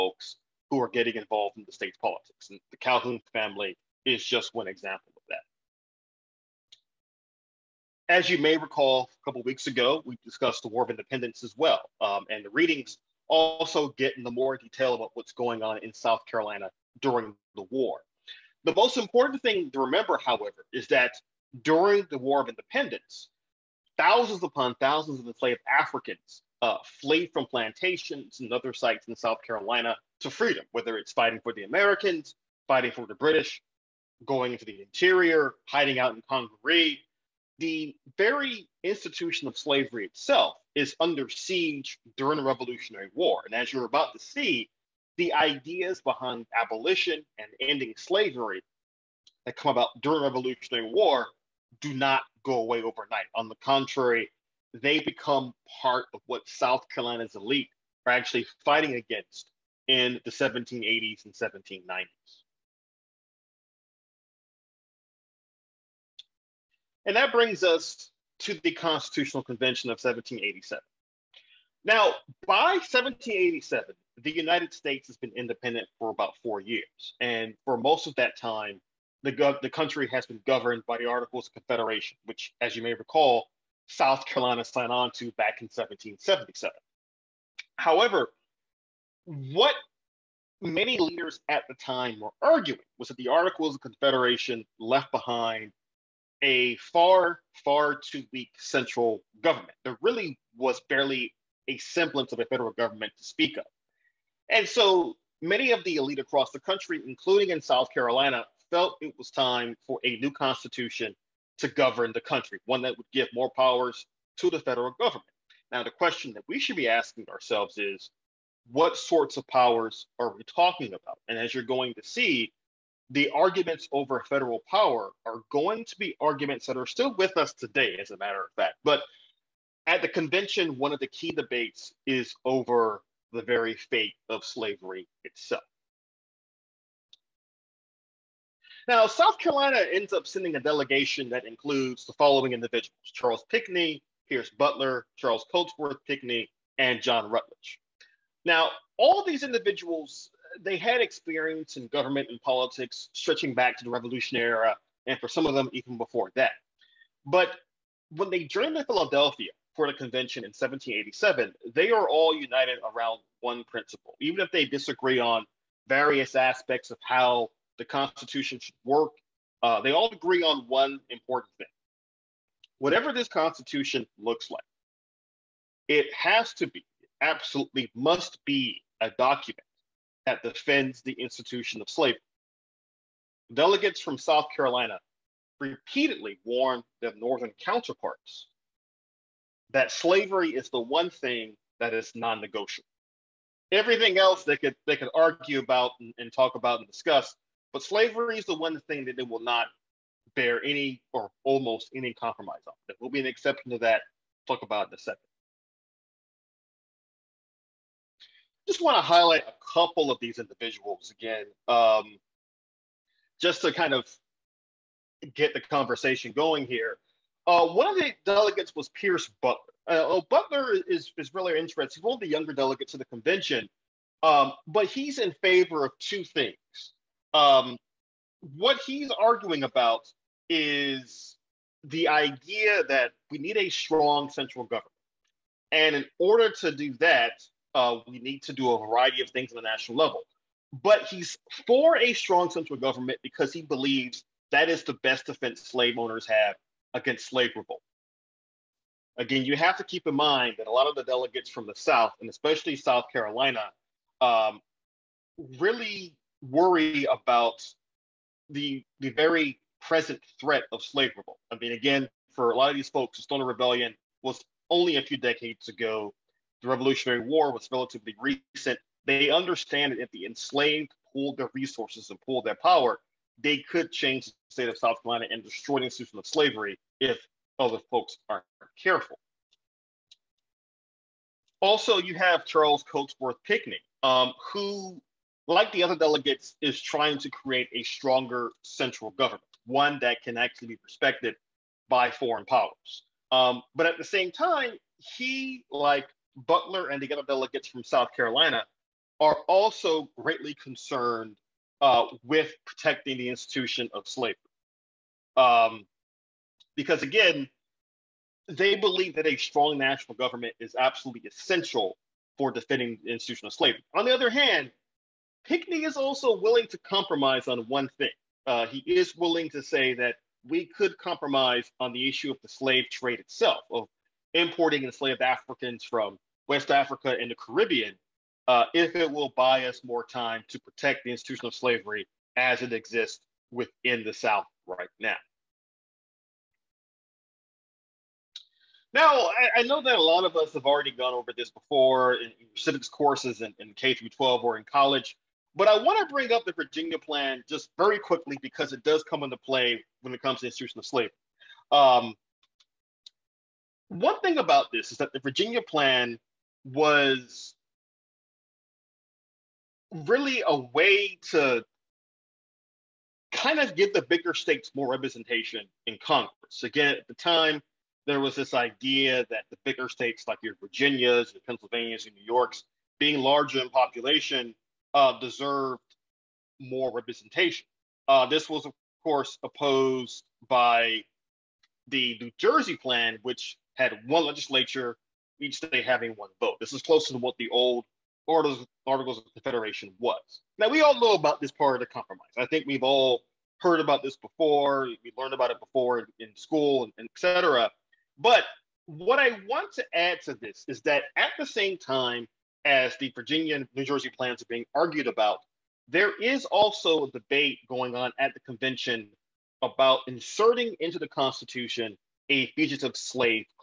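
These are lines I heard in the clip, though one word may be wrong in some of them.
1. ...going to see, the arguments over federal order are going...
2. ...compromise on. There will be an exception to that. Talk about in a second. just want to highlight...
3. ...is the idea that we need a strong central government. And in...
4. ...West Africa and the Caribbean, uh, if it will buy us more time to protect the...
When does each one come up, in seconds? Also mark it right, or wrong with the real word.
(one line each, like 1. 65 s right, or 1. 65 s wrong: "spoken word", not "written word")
1. 121 s wrong: "power", not "order"
2. 202 s right
3. 230 s right
4. 326 s right.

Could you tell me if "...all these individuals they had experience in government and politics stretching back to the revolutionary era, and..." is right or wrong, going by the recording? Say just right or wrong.
right.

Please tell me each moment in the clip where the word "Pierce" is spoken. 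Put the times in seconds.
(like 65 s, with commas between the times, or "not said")
144 s, 218 s.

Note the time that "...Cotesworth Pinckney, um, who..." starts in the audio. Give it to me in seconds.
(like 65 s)
282 s.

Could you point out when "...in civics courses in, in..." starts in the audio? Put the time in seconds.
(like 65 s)
342 s.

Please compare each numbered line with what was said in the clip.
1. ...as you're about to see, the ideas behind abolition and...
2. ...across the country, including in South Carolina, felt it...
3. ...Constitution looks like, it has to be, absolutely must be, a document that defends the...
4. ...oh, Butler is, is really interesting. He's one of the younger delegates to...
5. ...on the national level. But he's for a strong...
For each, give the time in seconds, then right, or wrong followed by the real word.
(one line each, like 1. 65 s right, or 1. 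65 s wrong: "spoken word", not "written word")
1. 43 s right
2. 106 s right
3. 173 s right
4. 220 s right
5. 239 s right.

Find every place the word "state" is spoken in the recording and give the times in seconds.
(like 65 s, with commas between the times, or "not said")
1 s, 74 s, 274 s, 364 s, 369 s, 385 s.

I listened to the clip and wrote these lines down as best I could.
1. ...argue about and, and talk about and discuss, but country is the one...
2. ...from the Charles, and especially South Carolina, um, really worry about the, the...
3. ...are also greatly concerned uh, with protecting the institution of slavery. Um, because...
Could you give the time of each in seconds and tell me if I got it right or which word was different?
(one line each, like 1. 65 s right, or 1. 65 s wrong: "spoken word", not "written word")
1. 195 s wrong: "slavery", not "country"
2. 251 s wrong: "South", not "Charles"
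3. 299 s right.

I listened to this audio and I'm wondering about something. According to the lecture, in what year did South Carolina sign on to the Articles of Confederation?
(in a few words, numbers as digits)
1777.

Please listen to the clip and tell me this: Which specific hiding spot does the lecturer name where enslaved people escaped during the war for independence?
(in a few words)
Congaree.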